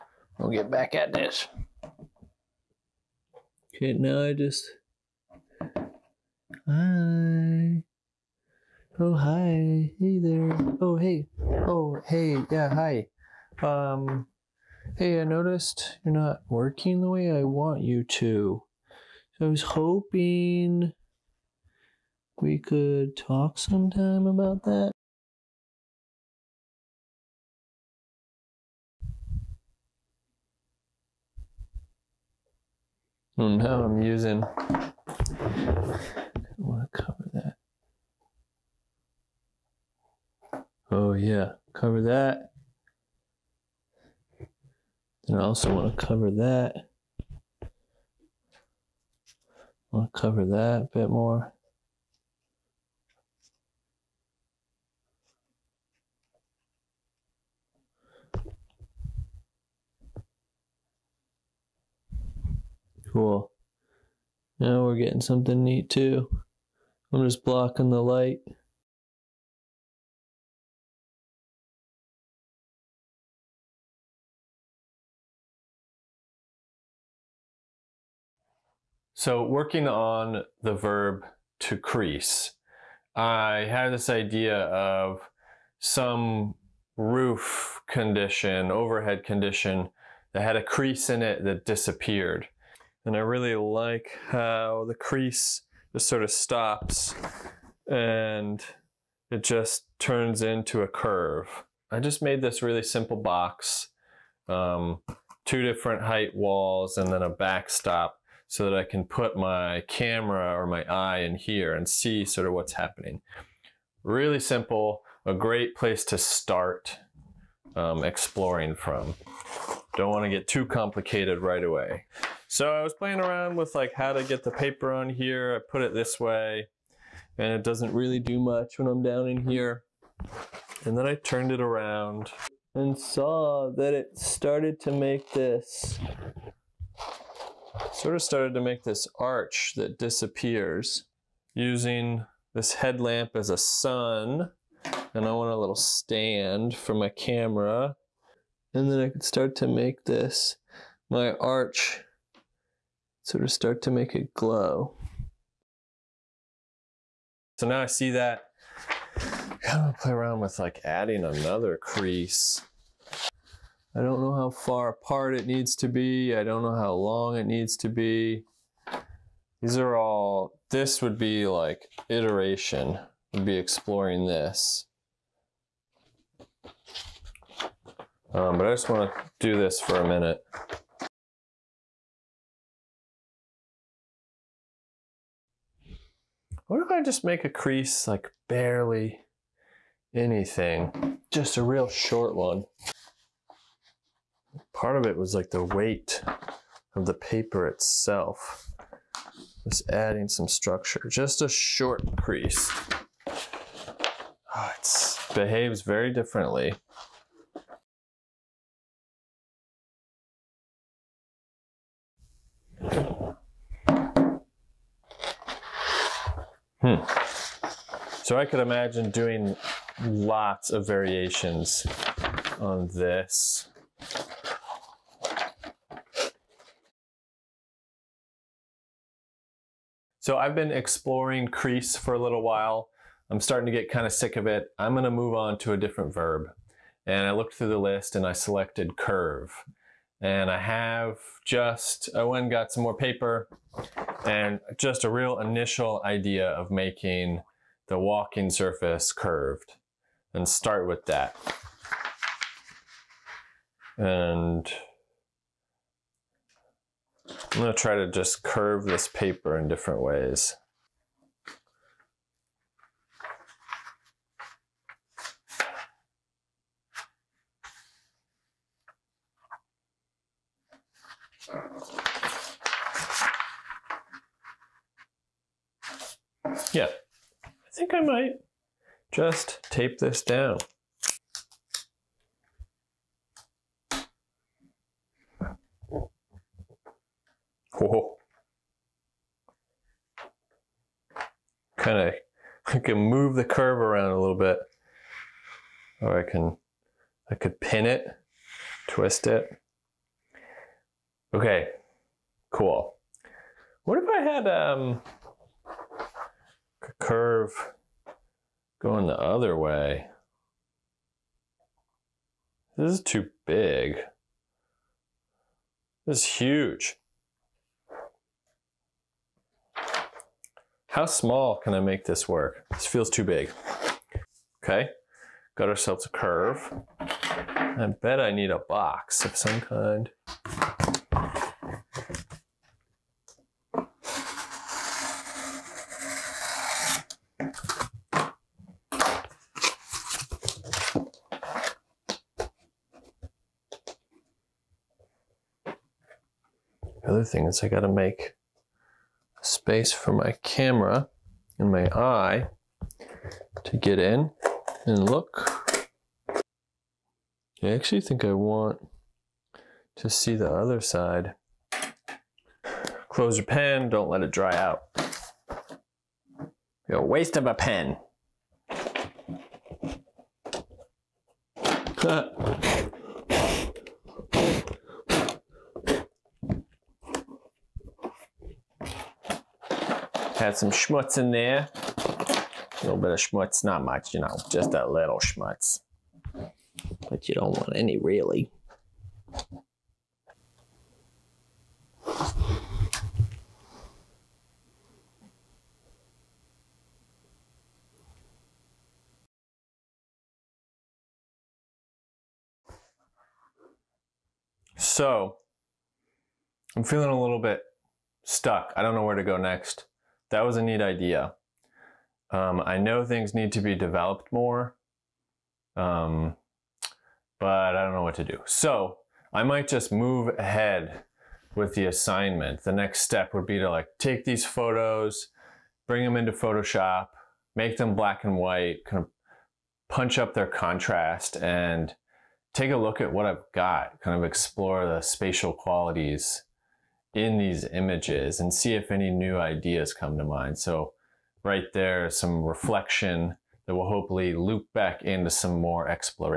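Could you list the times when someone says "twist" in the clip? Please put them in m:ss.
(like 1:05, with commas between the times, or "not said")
4:58.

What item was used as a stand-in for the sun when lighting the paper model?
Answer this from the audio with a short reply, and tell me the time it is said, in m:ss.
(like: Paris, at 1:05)
headlamp, at 2:22.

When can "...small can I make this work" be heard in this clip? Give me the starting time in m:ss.
5:21.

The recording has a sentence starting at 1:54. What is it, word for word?
Really simple, a great place to start um, exploring from.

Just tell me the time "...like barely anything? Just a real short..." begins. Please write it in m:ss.
3:08.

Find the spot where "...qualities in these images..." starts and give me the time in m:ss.
7:15.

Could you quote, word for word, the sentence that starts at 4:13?
And I'm gonna try to just curve this paper in different ways.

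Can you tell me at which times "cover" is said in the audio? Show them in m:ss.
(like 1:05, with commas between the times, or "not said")
0:41, 0:46, 0:50.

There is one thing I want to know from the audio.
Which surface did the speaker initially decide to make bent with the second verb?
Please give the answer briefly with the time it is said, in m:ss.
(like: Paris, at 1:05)
walking surface, at 4:07.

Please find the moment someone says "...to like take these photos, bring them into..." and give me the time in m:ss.
7:03.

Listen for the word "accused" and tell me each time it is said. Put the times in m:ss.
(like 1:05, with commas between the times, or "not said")
not said.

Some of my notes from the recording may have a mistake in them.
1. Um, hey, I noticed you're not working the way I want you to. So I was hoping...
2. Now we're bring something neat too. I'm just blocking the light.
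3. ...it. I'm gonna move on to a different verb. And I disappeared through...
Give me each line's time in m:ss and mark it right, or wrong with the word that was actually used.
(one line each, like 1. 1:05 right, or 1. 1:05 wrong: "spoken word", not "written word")
1. 0:13 right
2. 1:04 wrong: "getting", not "bring"
3. 3:54 wrong: "looked", not "disappeared".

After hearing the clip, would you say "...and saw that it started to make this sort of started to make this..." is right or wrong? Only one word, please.
right.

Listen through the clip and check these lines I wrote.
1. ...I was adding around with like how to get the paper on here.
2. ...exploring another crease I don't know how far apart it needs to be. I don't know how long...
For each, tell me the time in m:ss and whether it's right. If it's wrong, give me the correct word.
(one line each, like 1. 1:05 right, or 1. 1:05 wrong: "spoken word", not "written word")
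1. 2:02 wrong: "playing", not "adding"
2. 2:40 wrong: "adding", not "exploring".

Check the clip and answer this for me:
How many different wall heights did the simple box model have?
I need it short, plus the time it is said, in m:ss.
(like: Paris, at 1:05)
2, at 1:45.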